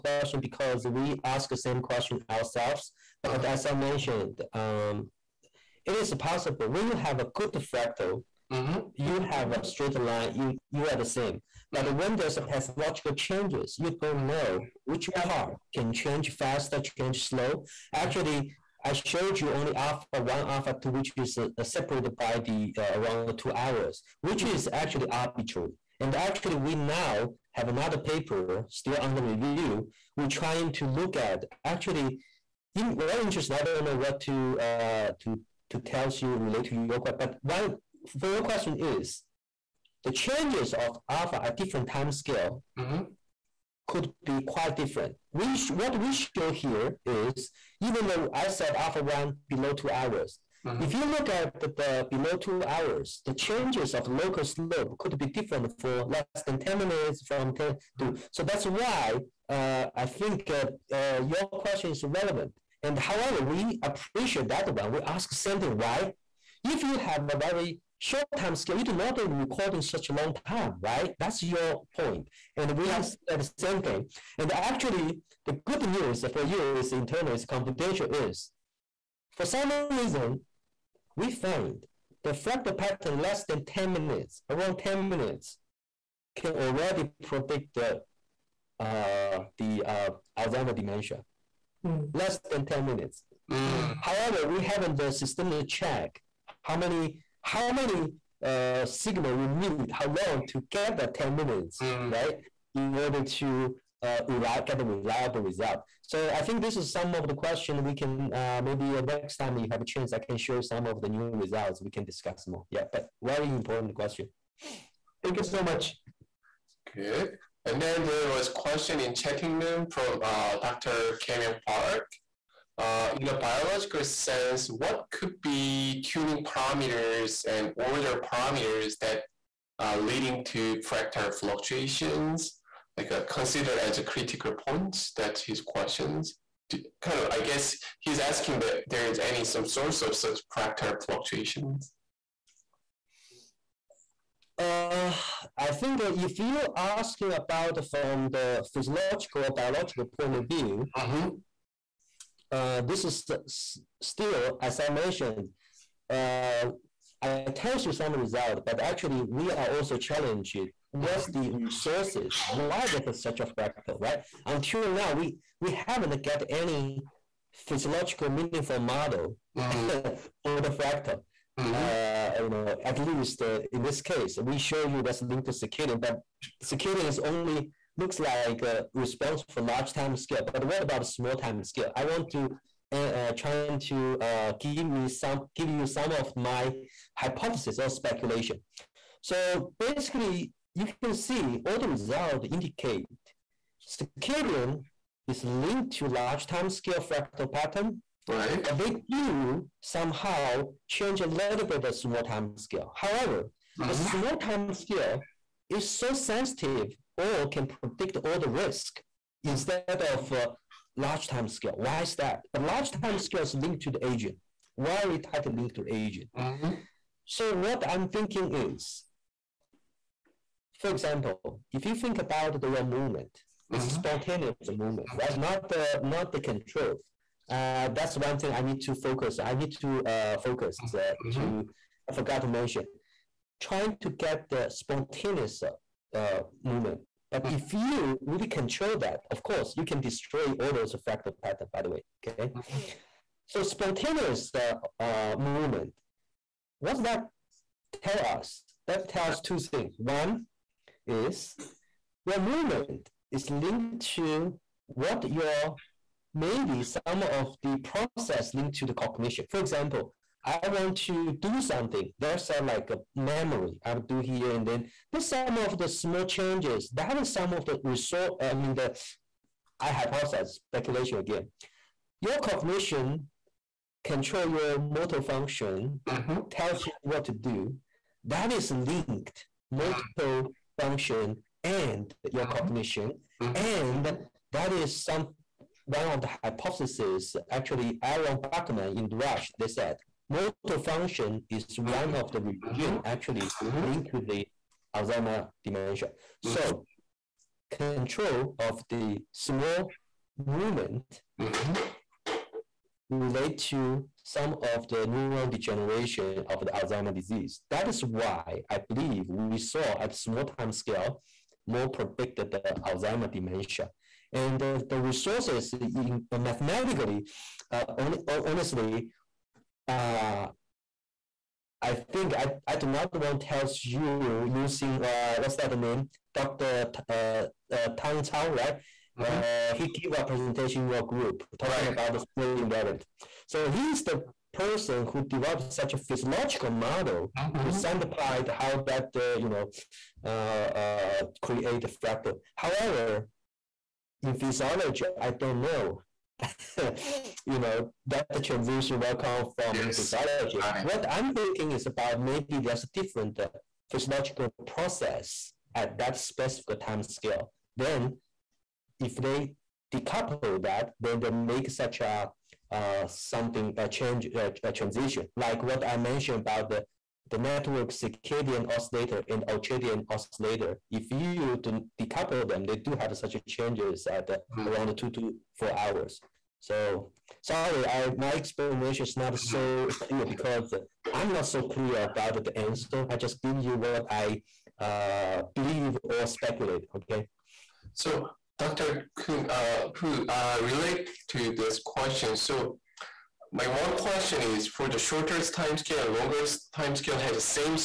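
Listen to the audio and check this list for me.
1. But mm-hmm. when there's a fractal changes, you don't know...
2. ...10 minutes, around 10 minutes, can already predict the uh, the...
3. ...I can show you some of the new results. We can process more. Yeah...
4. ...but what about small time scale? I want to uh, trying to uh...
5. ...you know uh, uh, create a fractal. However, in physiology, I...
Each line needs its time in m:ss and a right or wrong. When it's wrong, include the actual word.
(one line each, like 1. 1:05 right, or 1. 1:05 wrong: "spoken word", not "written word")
1. 0:11 wrong: "pathological", not "fractal"
2. 1:23 right
3. 1:50 wrong: "discuss", not "process"
4. 3:00 right
5. 5:39 right.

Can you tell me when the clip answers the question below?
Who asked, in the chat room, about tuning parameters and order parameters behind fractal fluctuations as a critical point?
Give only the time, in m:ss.
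2:01.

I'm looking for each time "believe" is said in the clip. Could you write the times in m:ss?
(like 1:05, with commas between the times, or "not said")
5:08, 6:25.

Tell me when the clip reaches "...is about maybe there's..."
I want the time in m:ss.
5:51.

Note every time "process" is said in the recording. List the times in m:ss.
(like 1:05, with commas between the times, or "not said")
4:17, 5:54.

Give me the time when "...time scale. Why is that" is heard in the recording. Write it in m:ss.
3:31.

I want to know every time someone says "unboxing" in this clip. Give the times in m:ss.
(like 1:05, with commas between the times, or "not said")
not said.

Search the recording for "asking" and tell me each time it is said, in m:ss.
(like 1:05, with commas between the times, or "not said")
2:18, 2:26.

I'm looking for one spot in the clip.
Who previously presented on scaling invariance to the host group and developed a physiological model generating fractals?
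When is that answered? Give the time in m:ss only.
5:27.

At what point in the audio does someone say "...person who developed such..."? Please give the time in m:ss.
5:34.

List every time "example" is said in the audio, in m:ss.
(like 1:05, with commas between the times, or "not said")
3:40, 4:19.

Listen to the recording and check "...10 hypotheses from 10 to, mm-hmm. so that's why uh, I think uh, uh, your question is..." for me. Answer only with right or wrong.
wrong.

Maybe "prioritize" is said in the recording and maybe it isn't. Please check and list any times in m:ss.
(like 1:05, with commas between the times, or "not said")
not said.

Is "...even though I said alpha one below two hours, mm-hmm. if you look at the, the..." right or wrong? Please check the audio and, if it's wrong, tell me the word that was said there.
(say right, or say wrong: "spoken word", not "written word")
right.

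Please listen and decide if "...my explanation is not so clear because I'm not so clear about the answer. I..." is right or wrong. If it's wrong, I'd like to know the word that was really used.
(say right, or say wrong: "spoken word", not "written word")
right.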